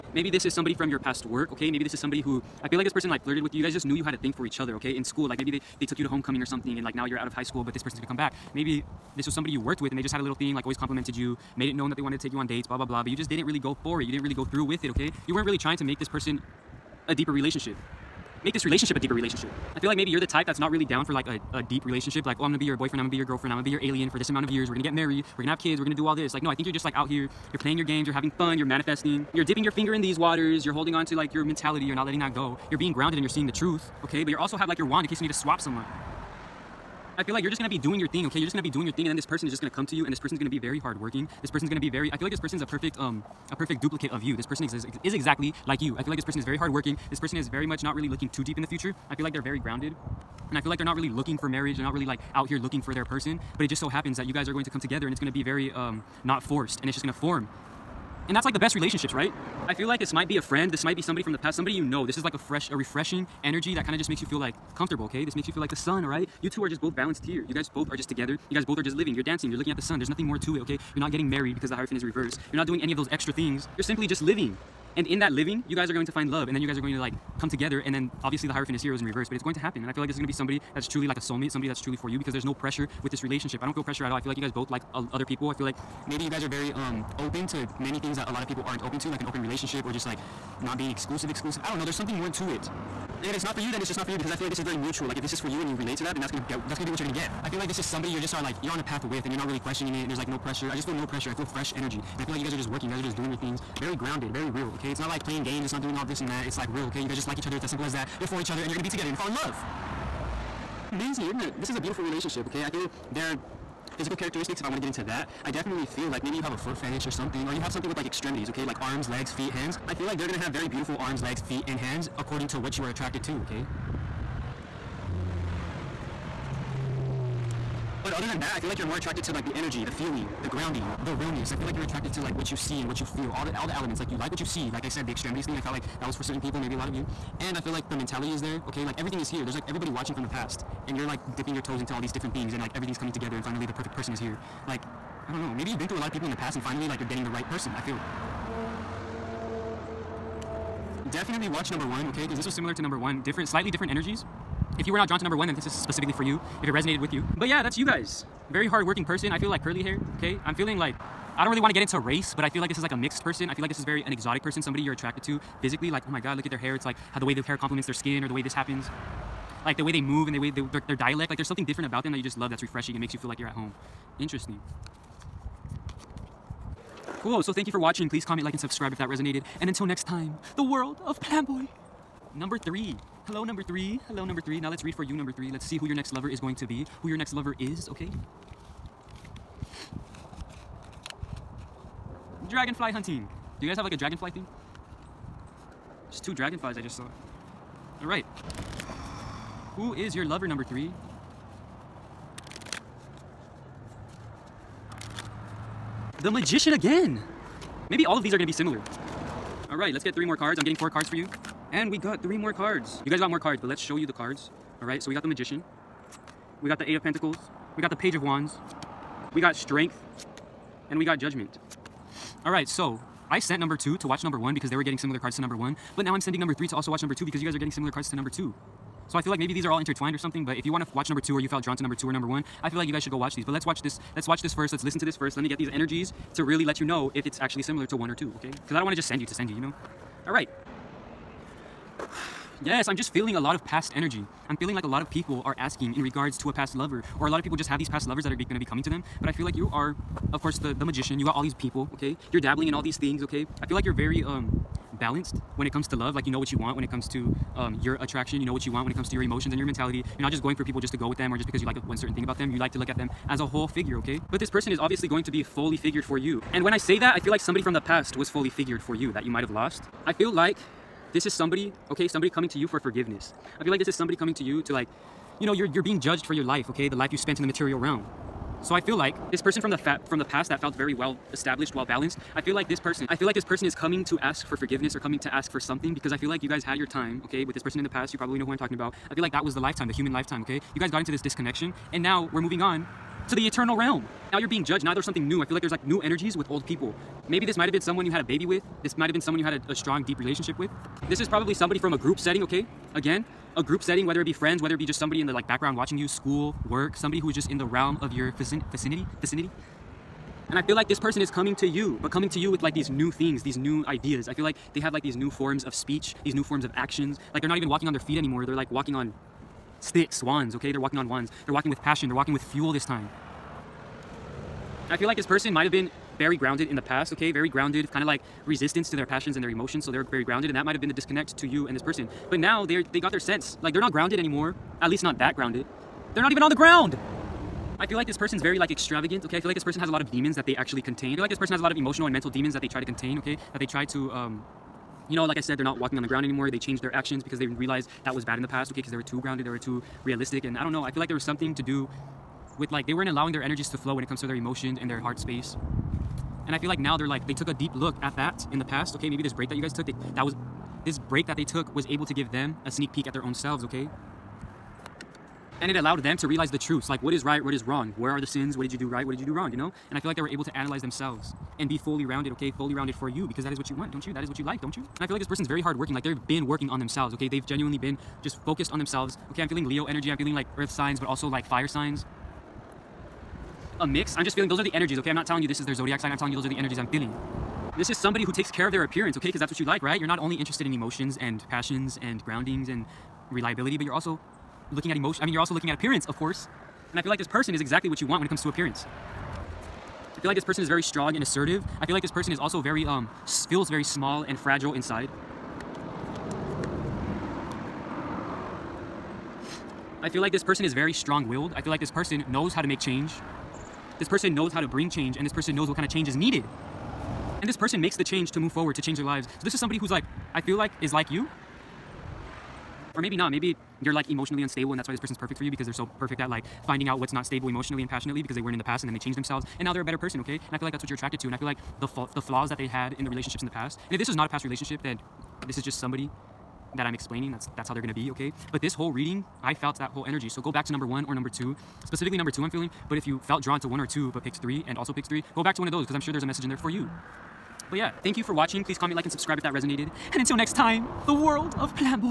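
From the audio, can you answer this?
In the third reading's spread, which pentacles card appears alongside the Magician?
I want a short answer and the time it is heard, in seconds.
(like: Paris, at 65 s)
Eight of Pentacles, at 216 s.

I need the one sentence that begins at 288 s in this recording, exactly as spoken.
You probably know who I'm talking about.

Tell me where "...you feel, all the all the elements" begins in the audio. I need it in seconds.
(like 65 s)
133 s.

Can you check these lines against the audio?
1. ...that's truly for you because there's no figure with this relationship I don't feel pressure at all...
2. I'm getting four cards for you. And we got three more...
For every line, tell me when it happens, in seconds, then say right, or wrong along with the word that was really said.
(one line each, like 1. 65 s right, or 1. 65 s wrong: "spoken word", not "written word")
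1. 81 s wrong: "pressure", not "figure"
2. 210 s right.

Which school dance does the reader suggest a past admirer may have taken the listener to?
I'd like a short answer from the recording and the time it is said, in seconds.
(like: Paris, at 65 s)
Homecoming, at 6 s.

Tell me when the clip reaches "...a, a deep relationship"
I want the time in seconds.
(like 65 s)
21 s.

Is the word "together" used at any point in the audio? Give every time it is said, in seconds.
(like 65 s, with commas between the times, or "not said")
54 s, 68 s, 77 s, 108 s, 143 s.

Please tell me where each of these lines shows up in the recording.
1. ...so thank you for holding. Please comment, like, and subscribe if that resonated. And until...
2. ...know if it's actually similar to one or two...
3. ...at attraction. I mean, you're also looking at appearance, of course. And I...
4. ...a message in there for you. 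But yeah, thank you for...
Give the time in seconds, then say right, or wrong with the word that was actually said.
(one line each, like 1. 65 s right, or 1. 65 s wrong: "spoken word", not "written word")
1. 177 s wrong: "watching", not "holding"
2. 236 s right
3. 394 s wrong: "emotion", not "attraction"
4. 446 s right.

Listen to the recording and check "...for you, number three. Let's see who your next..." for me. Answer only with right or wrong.
right.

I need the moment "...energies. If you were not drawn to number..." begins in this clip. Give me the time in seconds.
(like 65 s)
153 s.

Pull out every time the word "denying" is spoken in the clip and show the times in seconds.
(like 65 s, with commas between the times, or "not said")
not said.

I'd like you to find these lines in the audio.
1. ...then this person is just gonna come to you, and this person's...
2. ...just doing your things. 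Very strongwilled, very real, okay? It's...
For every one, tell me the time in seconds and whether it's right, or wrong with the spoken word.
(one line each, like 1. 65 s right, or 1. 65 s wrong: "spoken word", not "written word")
1. 39 s right
2. 103 s wrong: "grounded", not "strongwilled".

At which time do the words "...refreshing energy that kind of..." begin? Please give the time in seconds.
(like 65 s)
62 s.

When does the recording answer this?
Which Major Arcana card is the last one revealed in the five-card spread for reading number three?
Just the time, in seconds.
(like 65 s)
221 s.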